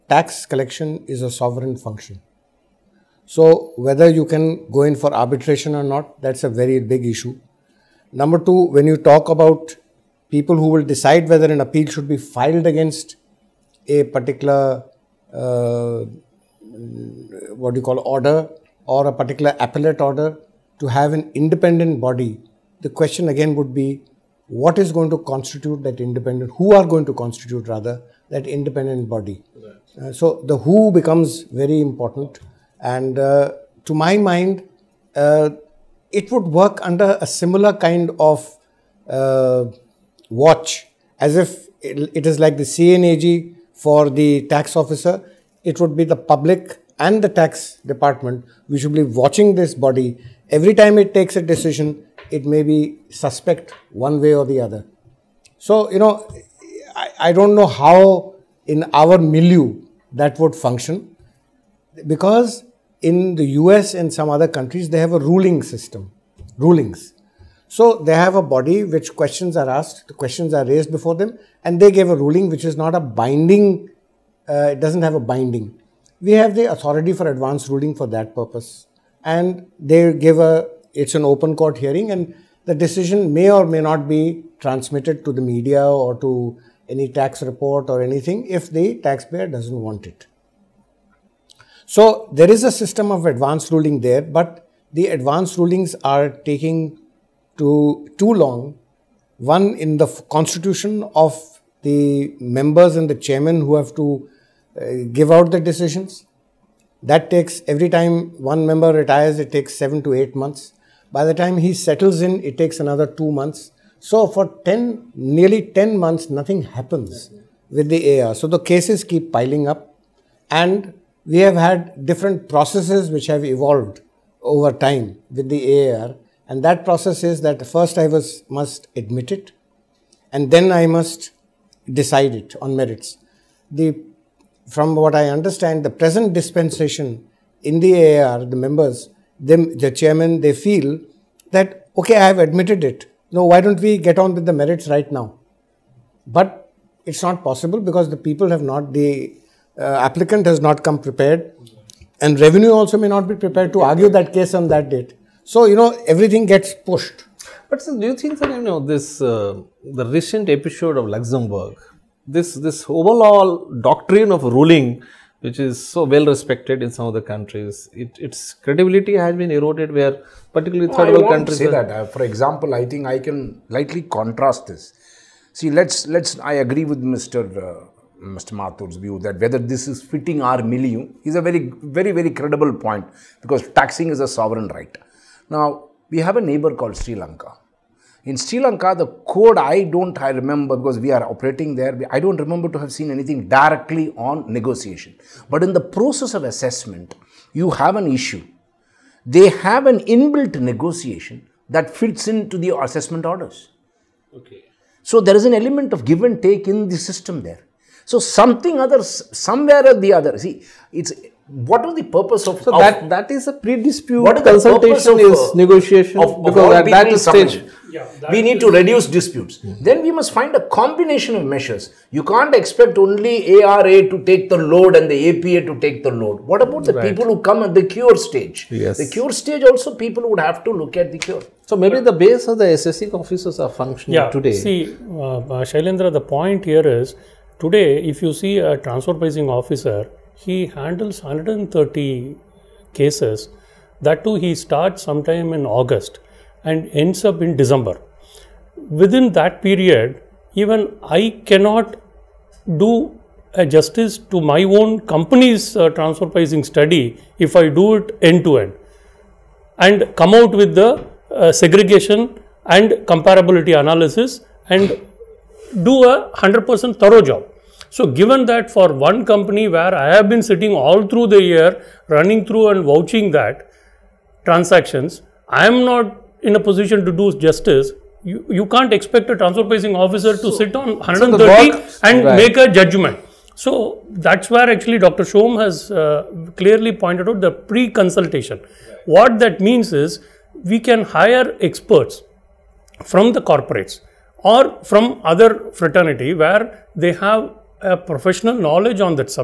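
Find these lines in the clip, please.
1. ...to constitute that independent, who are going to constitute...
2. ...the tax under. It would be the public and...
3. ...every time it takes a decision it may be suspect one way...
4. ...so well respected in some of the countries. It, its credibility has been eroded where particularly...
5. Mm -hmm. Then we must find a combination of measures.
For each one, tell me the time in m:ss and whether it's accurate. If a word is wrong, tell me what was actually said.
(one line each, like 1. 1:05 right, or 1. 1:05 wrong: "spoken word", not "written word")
1. 0:25 right
2. 0:44 wrong: "officer", not "under"
3. 0:50 right
4. 2:45 right
5. 3:39 right.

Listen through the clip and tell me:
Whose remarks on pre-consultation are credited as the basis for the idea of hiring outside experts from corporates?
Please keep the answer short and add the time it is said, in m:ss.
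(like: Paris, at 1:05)
Dr. Shome, at 4:44.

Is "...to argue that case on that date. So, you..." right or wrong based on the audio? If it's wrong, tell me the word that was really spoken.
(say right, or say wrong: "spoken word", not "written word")
right.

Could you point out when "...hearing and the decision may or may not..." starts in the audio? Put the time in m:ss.
1:21.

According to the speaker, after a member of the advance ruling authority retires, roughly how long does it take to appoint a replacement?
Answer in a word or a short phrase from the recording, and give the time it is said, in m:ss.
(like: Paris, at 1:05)
7 to 8 months, at 1:49.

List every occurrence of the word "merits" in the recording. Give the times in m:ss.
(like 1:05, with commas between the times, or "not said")
2:12, 2:24.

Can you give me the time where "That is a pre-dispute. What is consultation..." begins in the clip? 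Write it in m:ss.
3:33.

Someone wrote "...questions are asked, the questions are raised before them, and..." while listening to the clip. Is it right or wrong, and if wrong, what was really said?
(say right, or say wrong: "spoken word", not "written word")
right.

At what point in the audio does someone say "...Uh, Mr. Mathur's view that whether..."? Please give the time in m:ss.
2:57.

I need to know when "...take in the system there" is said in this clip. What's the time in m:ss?
3:26.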